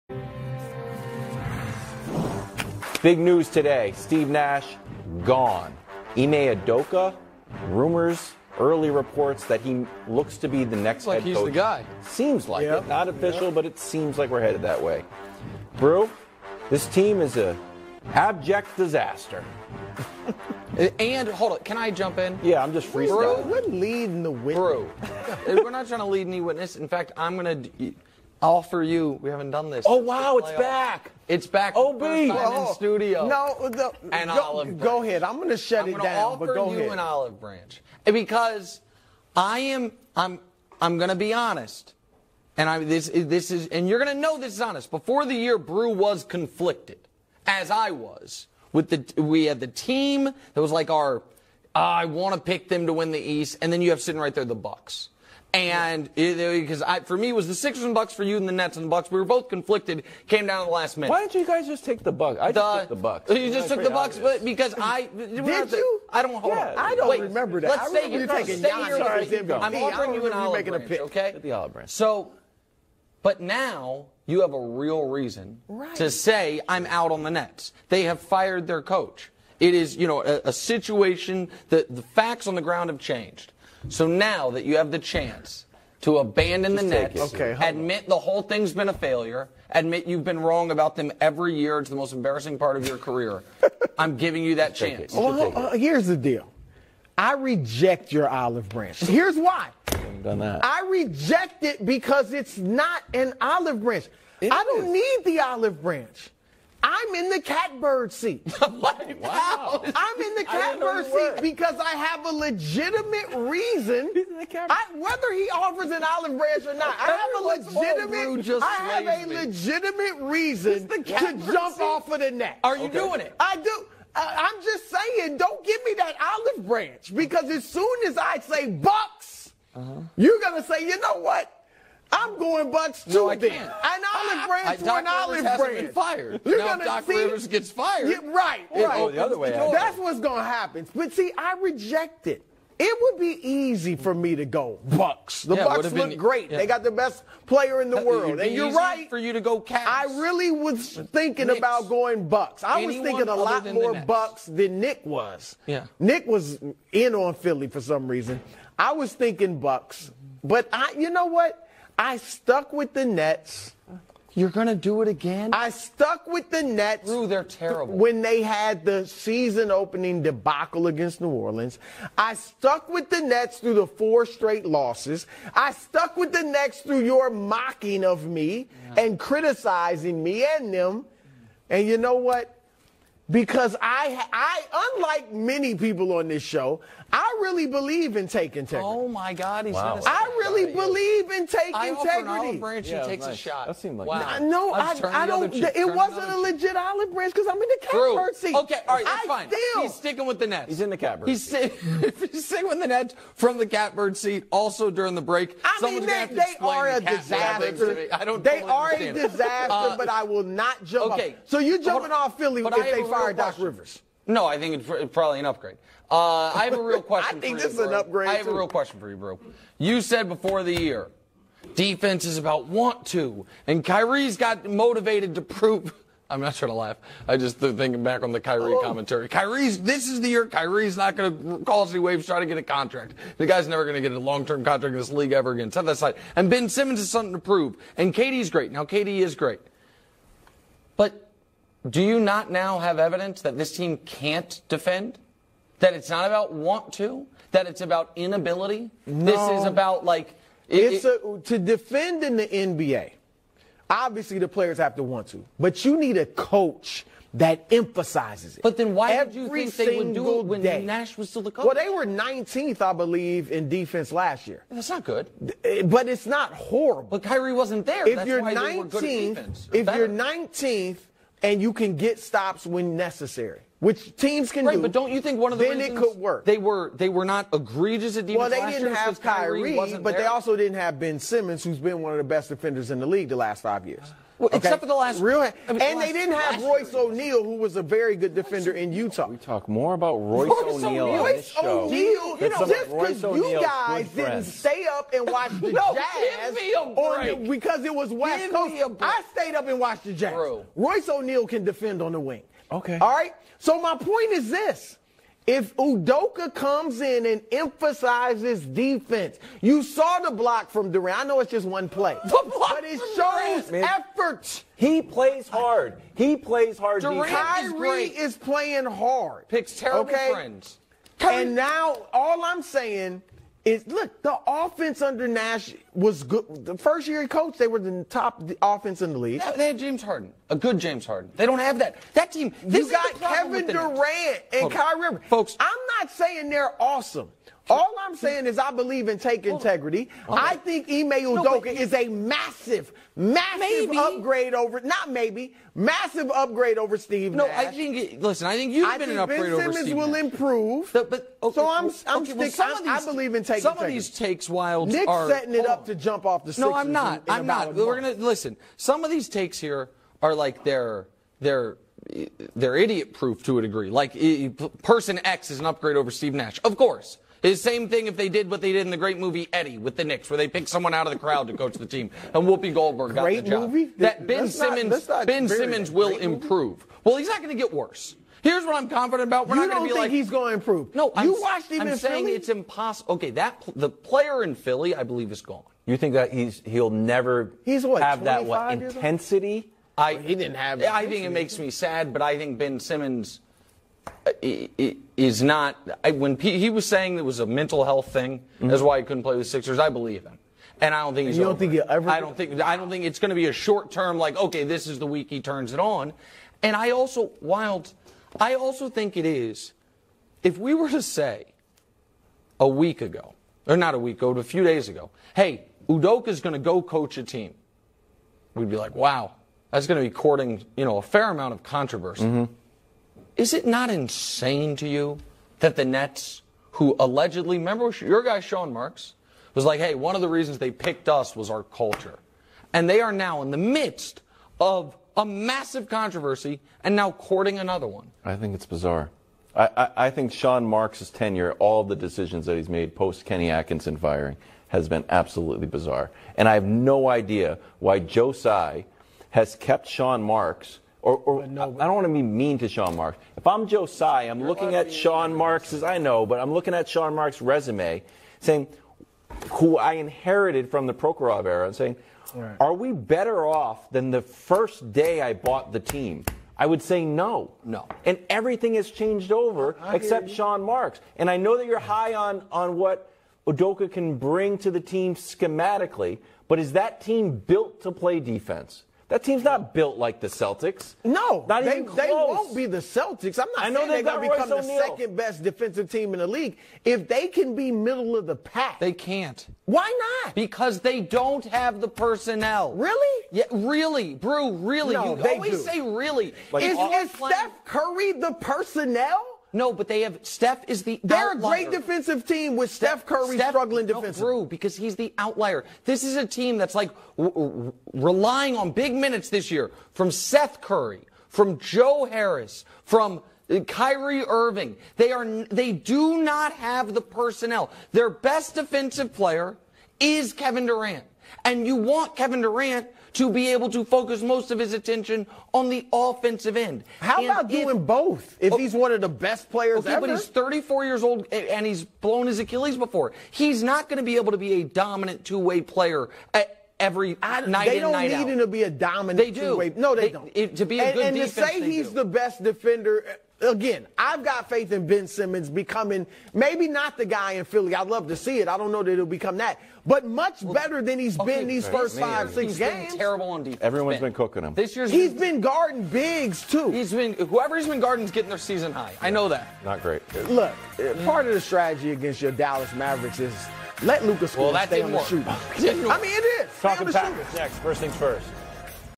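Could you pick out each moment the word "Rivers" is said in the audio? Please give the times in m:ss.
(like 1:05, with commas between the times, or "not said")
2:17, 3:33.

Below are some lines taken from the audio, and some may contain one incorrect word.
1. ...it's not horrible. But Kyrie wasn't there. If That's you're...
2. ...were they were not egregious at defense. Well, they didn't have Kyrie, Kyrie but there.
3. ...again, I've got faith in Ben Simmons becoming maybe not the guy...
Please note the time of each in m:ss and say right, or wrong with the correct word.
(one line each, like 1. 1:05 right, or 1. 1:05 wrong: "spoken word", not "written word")
1. 4:26 right
2. 4:36 right
3. 9:03 right.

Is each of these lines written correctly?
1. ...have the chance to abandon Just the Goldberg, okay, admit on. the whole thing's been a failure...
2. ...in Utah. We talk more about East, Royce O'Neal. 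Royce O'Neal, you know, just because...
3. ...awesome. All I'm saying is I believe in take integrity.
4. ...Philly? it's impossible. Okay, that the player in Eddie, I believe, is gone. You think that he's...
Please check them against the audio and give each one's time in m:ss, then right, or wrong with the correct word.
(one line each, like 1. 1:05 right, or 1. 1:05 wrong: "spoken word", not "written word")
1. 1:24 wrong: "Nets", not "Goldberg"
2. 4:48 wrong: "Royce", not "East"
3. 5:36 right
4. 6:22 wrong: "Philly", not "Eddie".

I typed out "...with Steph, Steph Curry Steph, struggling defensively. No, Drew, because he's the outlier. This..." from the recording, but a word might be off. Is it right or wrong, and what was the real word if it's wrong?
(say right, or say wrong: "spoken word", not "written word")
right.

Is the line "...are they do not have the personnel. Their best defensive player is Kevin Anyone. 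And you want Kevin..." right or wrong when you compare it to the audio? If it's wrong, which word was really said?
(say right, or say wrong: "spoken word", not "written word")
wrong: "Durant", not "Anyone".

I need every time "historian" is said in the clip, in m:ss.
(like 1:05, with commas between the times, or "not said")
not said.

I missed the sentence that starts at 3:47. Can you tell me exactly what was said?
I just thinking back on the Kyrie oh.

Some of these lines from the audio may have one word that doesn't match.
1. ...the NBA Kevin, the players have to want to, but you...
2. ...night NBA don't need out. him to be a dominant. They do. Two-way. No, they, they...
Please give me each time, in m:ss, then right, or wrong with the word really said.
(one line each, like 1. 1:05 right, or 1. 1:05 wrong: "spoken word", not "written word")
1. 4:12 wrong: "Obviously", not "Kevin"
2. 8:57 wrong: "They", not "NBA".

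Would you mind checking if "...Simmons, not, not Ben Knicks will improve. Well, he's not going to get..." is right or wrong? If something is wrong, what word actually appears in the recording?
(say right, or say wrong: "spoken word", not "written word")
wrong: "Simmons", not "Knicks".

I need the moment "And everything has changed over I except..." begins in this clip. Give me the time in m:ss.
7:48.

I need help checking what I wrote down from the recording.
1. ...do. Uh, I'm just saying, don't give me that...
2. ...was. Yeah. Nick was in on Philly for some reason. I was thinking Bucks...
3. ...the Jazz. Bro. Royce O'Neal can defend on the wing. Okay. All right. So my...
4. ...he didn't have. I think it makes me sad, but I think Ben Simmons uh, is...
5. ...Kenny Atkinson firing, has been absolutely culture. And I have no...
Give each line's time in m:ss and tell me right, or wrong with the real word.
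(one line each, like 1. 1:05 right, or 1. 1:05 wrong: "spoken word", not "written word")
1. 2:03 right
2. 2:35 right
3. 5:00 right
4. 6:30 right
5. 7:23 wrong: "bizarre", not "culture".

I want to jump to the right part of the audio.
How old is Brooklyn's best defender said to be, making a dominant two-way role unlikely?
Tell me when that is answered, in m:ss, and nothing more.
8:50.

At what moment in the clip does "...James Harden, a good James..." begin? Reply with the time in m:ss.
5:29.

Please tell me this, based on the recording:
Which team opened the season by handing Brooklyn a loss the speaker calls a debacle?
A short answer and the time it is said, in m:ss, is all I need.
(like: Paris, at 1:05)
New Orleans, at 2:51.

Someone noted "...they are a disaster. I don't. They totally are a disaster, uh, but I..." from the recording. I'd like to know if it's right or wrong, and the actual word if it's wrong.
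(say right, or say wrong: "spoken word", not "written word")
right.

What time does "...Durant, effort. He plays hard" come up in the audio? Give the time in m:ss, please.
5:13.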